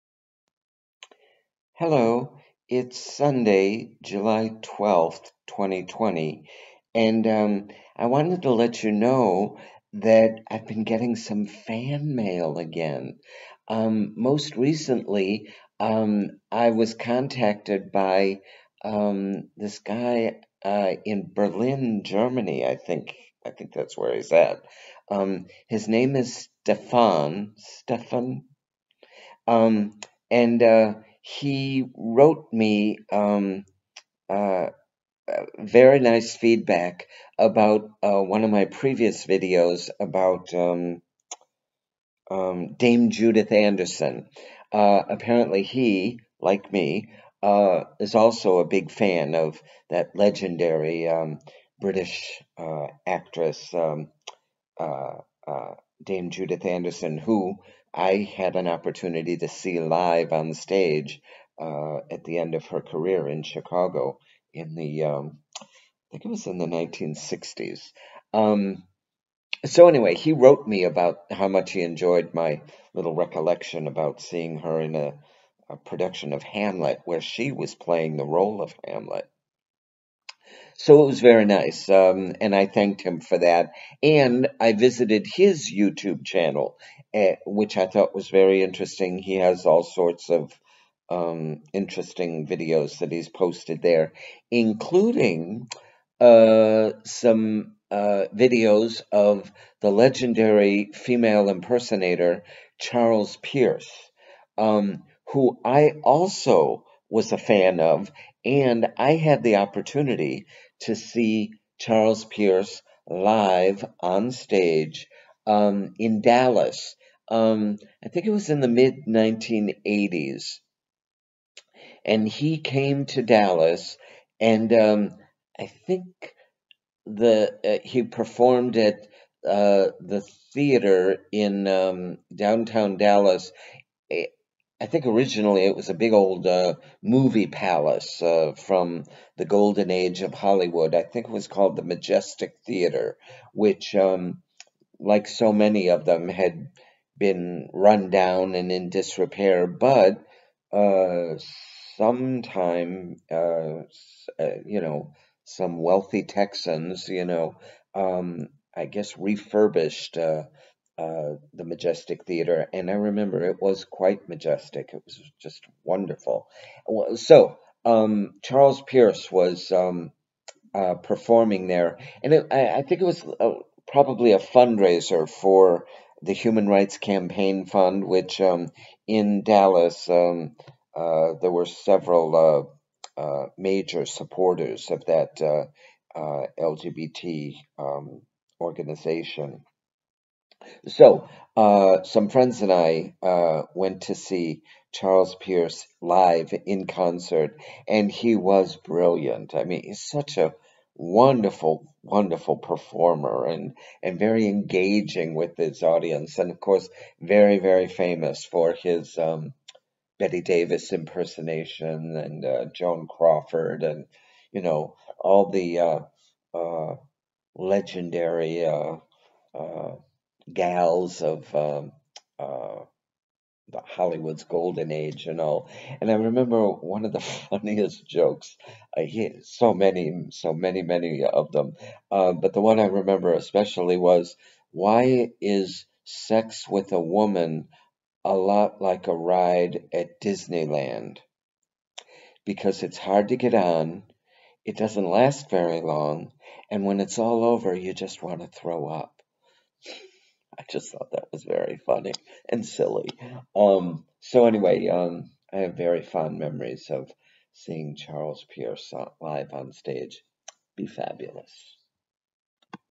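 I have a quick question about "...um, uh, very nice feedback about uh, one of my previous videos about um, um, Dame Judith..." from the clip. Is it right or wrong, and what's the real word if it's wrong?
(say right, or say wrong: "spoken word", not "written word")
right.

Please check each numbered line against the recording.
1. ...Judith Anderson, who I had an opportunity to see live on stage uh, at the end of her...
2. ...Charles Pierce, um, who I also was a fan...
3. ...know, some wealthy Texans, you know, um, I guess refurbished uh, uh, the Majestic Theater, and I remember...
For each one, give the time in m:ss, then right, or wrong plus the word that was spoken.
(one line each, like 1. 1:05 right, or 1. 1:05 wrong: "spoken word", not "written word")
1. 0:56 right
2. 1:42 right
3. 2:34 right.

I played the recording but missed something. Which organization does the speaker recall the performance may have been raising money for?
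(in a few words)
Human Rights Campaign Fund.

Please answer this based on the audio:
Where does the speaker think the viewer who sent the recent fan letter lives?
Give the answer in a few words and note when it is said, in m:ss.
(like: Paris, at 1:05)
Berlin, at 0:21.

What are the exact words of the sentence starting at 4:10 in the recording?
I just thought that was very funny and silly.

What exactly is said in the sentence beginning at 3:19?
I mean, he's such a wonderful, wonderful performer and, and very engaging with his audience.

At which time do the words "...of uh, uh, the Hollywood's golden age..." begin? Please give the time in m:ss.
3:41.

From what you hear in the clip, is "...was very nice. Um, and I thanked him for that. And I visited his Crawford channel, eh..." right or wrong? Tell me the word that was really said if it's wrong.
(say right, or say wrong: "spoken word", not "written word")
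wrong: "YouTube", not "Crawford".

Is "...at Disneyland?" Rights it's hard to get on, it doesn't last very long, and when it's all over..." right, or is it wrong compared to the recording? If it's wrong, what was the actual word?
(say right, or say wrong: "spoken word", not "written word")
wrong: "Because", not "Rights".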